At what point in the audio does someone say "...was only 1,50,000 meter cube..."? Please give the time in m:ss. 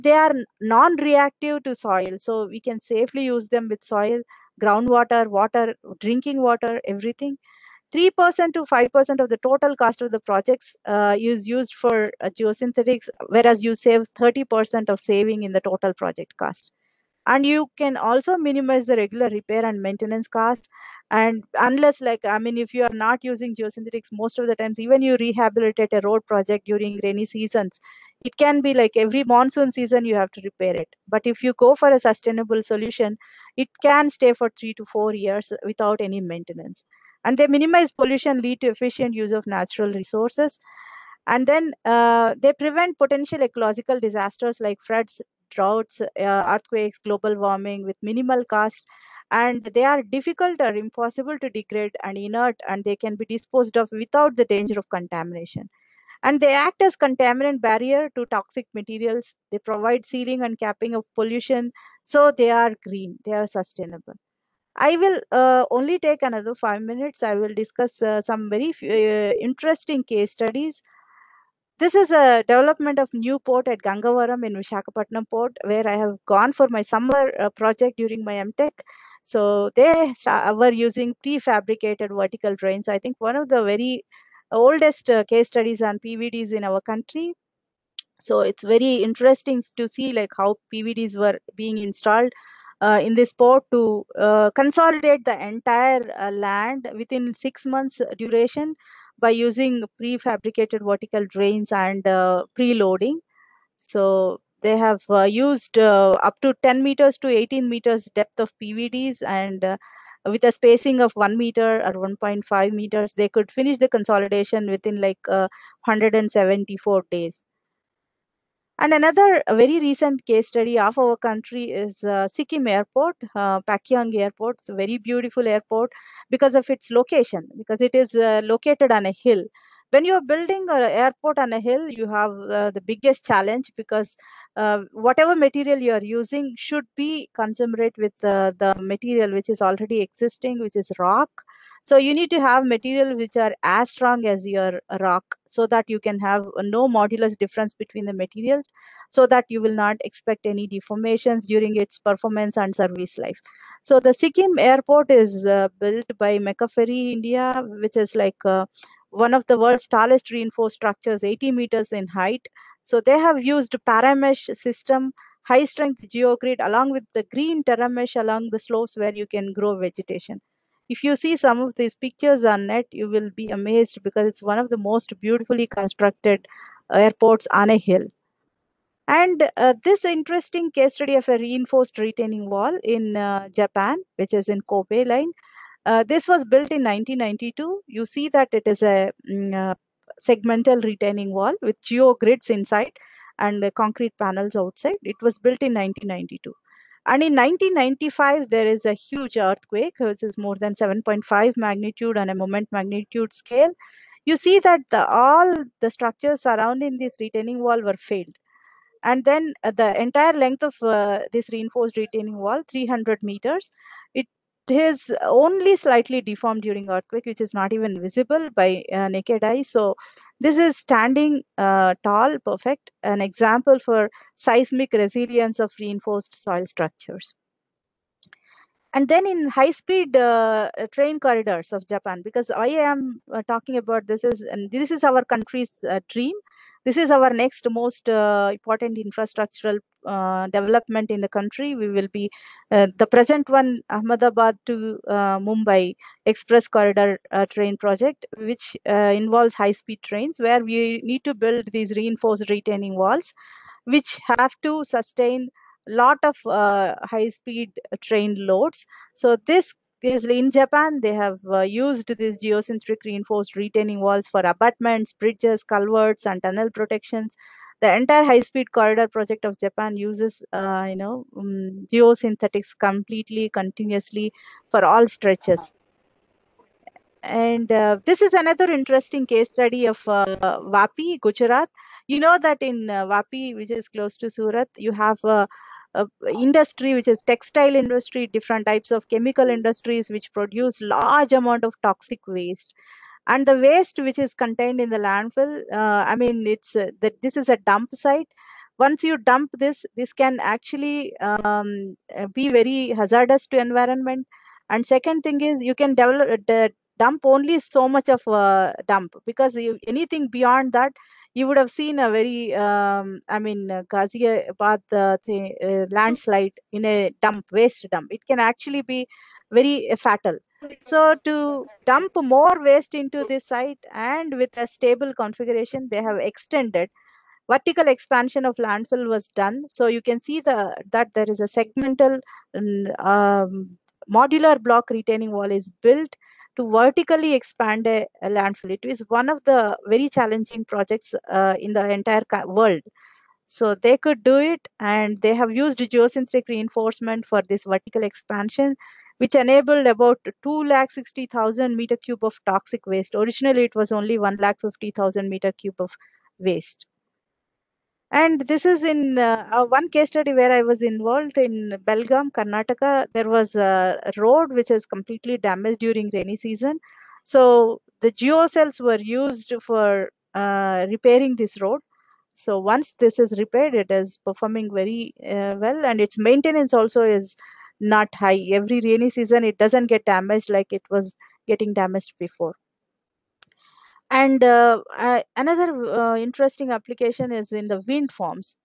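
5:53.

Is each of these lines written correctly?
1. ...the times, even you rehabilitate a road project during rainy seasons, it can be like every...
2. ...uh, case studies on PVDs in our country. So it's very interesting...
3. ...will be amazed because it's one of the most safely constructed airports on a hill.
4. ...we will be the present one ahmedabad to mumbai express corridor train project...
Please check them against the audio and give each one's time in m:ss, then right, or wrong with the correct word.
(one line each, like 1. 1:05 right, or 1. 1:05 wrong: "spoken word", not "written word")
1. 0:24 right
2. 1:25 right
3. 2:53 wrong: "beautifully", not "safely"
4. 4:01 right.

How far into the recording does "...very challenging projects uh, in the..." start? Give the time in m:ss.
5:39.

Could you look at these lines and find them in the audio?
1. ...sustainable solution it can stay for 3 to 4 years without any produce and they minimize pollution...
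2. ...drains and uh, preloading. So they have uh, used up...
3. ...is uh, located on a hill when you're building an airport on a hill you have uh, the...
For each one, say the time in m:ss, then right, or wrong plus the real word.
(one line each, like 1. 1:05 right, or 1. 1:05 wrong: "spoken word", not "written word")
1. 0:31 wrong: "maintenance", not "produce"
2. 1:41 right
3. 2:07 right.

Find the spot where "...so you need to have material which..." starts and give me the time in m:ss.
2:21.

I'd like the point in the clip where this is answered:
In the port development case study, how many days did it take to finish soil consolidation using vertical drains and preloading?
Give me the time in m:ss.
1:55.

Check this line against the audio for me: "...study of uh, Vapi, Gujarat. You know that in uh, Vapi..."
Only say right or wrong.
right.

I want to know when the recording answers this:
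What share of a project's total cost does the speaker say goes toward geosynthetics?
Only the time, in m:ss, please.
0:07.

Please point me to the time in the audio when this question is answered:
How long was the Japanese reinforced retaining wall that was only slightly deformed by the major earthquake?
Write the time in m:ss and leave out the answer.
3:32.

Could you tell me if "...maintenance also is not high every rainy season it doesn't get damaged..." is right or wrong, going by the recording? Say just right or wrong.
right.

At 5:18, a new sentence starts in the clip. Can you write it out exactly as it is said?
It can actually be very uh, fatal.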